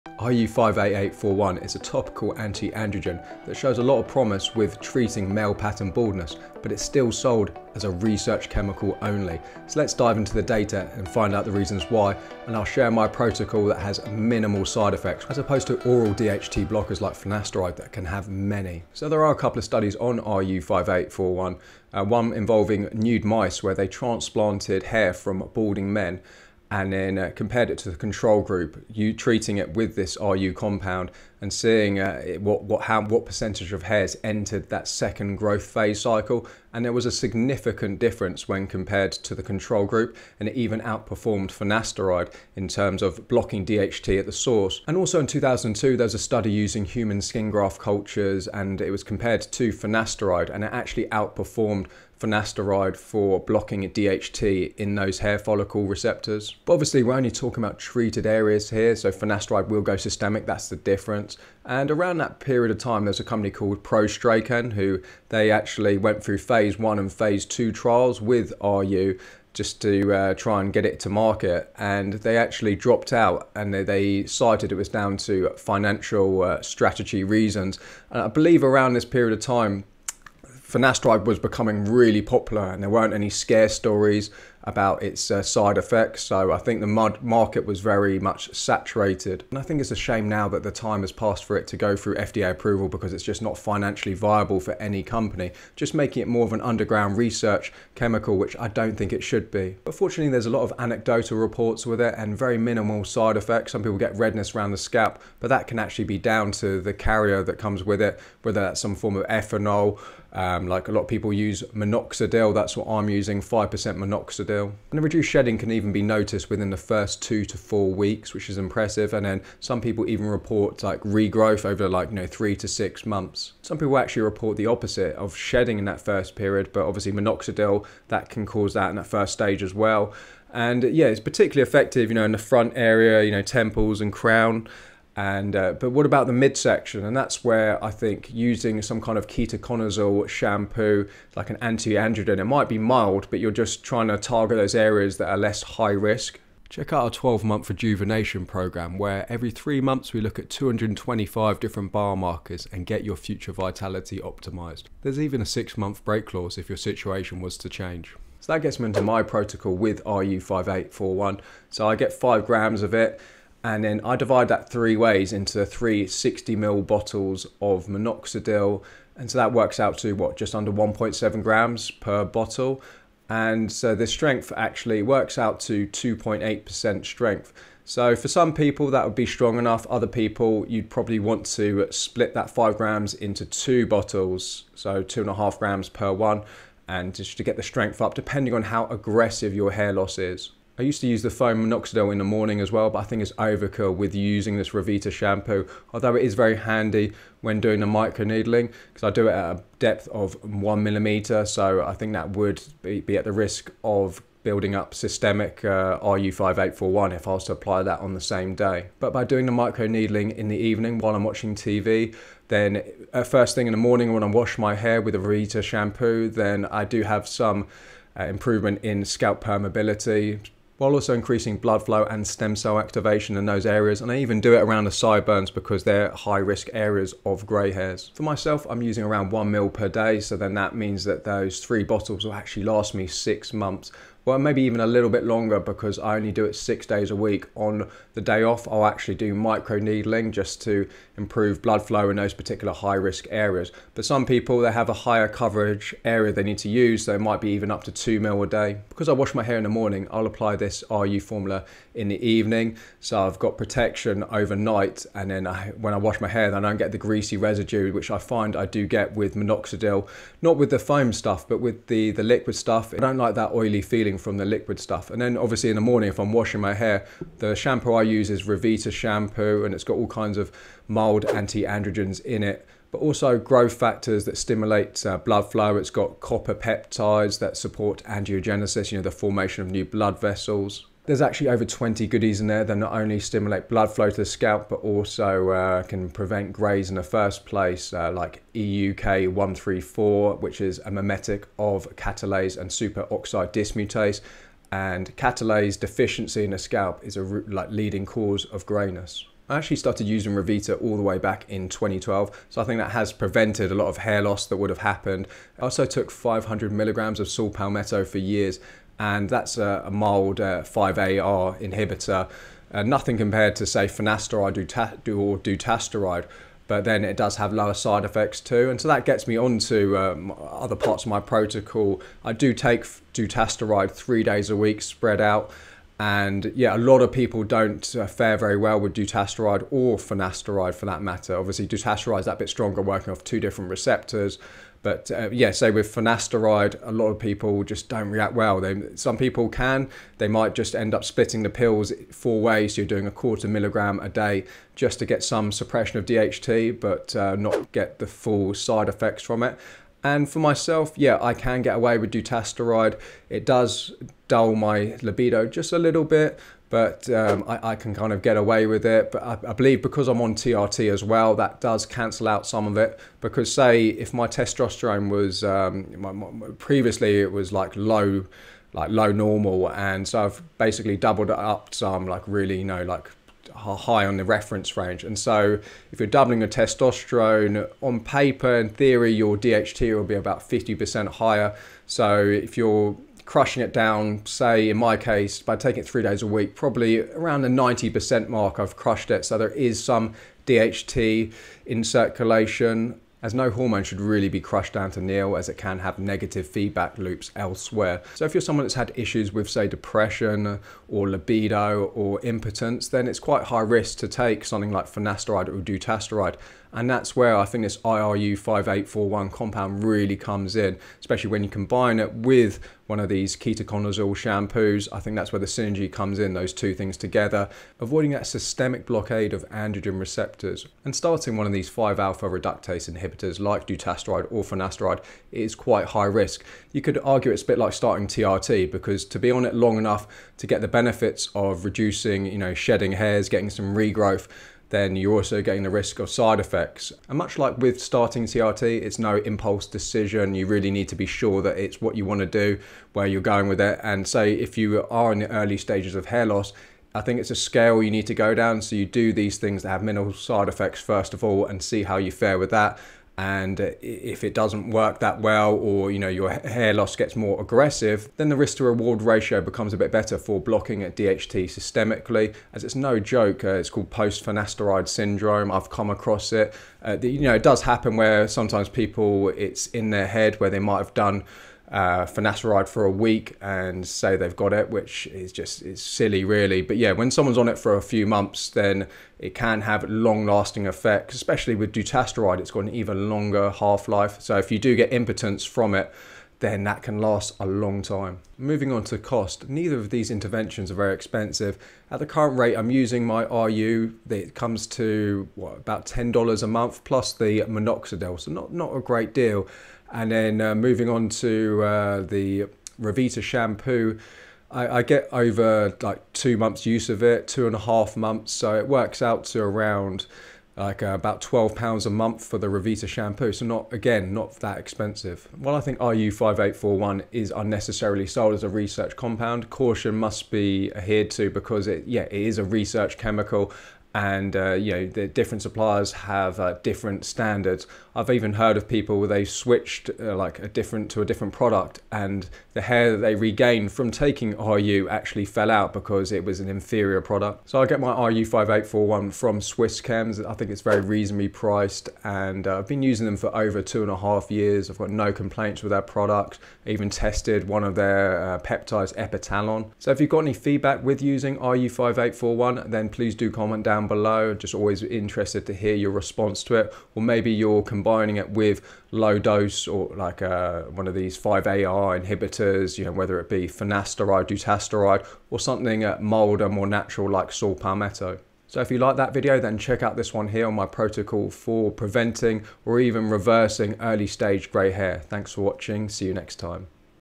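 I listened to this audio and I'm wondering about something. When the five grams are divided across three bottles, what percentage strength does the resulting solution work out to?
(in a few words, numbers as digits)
2.8%.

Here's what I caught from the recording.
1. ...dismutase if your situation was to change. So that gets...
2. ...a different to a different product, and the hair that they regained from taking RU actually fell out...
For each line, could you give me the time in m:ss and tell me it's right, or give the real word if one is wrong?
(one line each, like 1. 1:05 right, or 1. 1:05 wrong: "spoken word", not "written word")
1. 2:36 wrong: "clause", not "dismutase"
2. 8:50 right.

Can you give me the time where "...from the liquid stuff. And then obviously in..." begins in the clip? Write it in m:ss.
4:24.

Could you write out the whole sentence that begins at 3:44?
And I even do it around the sideburns because they're high risk areas of gray hairs.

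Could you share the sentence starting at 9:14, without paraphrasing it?
Just always interested to hear your response to it, or maybe your.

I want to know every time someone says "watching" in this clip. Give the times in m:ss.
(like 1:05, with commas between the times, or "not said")
3:31, 9:35.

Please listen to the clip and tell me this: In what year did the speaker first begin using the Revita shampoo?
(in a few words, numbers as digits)
2012.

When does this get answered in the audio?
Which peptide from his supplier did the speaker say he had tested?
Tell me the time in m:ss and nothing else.
9:08.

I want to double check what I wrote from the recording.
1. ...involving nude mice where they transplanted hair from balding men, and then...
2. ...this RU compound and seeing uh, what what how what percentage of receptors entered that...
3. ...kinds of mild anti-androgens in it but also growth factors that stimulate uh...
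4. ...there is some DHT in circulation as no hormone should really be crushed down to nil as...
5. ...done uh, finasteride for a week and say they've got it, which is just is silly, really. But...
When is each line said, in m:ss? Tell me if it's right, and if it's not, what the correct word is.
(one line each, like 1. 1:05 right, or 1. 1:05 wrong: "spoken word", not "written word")
1. 0:22 right
2. 0:29 wrong: "hairs", not "receptors"
3. 4:30 right
4. 6:29 right
5. 7:50 right.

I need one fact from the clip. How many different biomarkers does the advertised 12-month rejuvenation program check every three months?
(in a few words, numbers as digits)
225.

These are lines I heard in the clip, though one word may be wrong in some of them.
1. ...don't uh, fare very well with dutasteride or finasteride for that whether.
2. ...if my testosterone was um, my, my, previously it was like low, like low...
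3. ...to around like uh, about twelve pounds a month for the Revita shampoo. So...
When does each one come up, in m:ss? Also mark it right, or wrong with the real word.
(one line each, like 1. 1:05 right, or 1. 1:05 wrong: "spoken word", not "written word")
1. 5:27 wrong: "matter", not "whether"
2. 6:03 right
3. 8:29 right.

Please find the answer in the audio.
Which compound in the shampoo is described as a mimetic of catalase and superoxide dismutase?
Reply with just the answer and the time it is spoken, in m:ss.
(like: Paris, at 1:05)
EUK134, at 4:48.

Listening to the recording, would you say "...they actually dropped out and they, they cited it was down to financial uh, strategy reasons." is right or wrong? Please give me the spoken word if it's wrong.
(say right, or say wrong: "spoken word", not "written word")
right.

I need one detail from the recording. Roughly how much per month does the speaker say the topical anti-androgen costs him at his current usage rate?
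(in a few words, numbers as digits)
$10.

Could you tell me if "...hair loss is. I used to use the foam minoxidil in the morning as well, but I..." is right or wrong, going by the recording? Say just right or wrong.
right.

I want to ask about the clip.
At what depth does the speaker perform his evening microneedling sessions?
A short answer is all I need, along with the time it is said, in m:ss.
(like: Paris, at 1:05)
1 millimeter, at 3:20.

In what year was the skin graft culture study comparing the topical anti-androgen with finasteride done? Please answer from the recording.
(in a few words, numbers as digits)
2002.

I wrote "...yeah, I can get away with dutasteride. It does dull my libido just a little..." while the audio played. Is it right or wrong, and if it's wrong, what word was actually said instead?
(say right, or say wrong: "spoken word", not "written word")
right.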